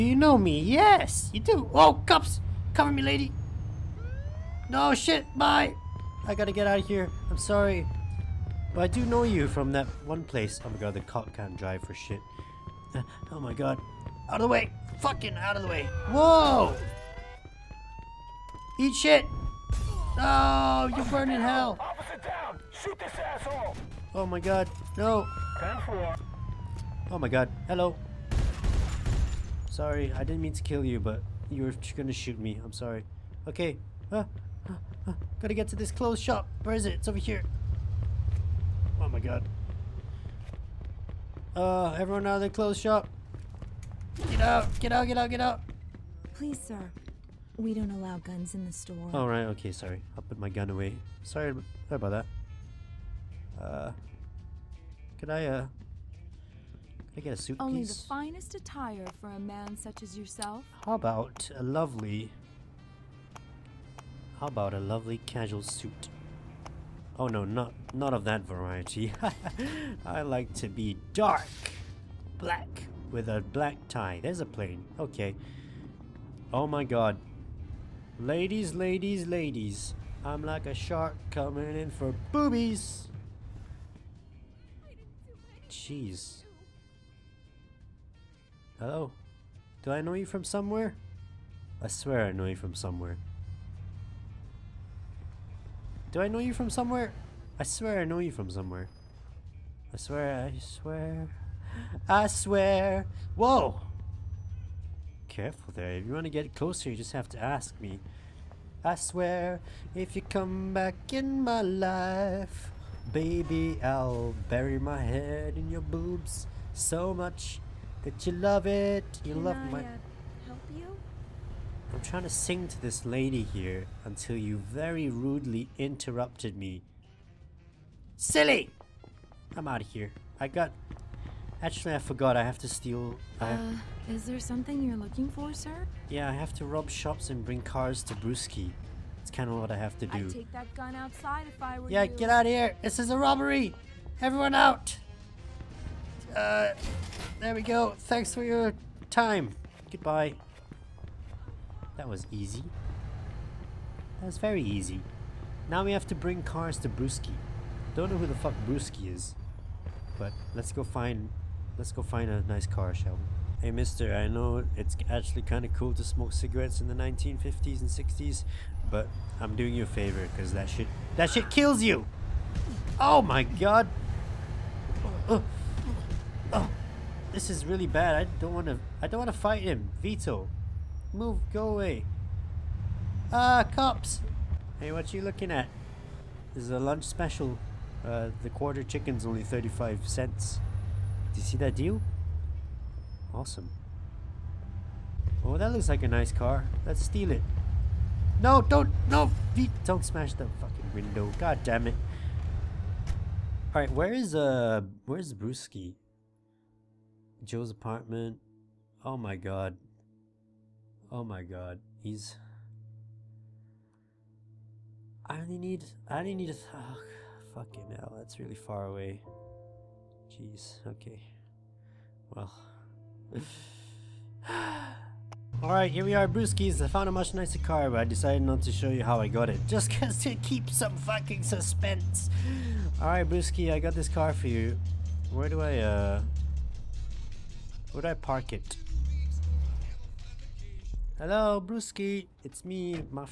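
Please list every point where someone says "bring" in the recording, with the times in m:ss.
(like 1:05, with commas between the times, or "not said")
2:17, 2:36.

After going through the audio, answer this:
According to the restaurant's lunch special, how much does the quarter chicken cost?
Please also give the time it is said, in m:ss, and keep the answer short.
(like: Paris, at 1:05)
35 cents, at 3:09.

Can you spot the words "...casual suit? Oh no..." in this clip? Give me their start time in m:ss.
1:05.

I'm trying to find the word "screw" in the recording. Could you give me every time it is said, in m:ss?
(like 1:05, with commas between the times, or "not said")
not said.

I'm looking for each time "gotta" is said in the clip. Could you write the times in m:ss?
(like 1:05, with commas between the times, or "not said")
0:06, 0:35.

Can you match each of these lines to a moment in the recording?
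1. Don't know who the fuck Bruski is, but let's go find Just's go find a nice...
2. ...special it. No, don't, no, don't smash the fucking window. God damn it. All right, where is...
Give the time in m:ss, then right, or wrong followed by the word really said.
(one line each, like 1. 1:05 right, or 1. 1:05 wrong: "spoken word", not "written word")
1. 2:37 wrong: "Let", not "Just"
2. 3:17 wrong: "steal", not "special".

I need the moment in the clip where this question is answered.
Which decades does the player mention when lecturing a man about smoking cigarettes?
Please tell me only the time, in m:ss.
2:46.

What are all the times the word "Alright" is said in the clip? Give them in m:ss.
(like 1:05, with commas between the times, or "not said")
3:45, 3:53.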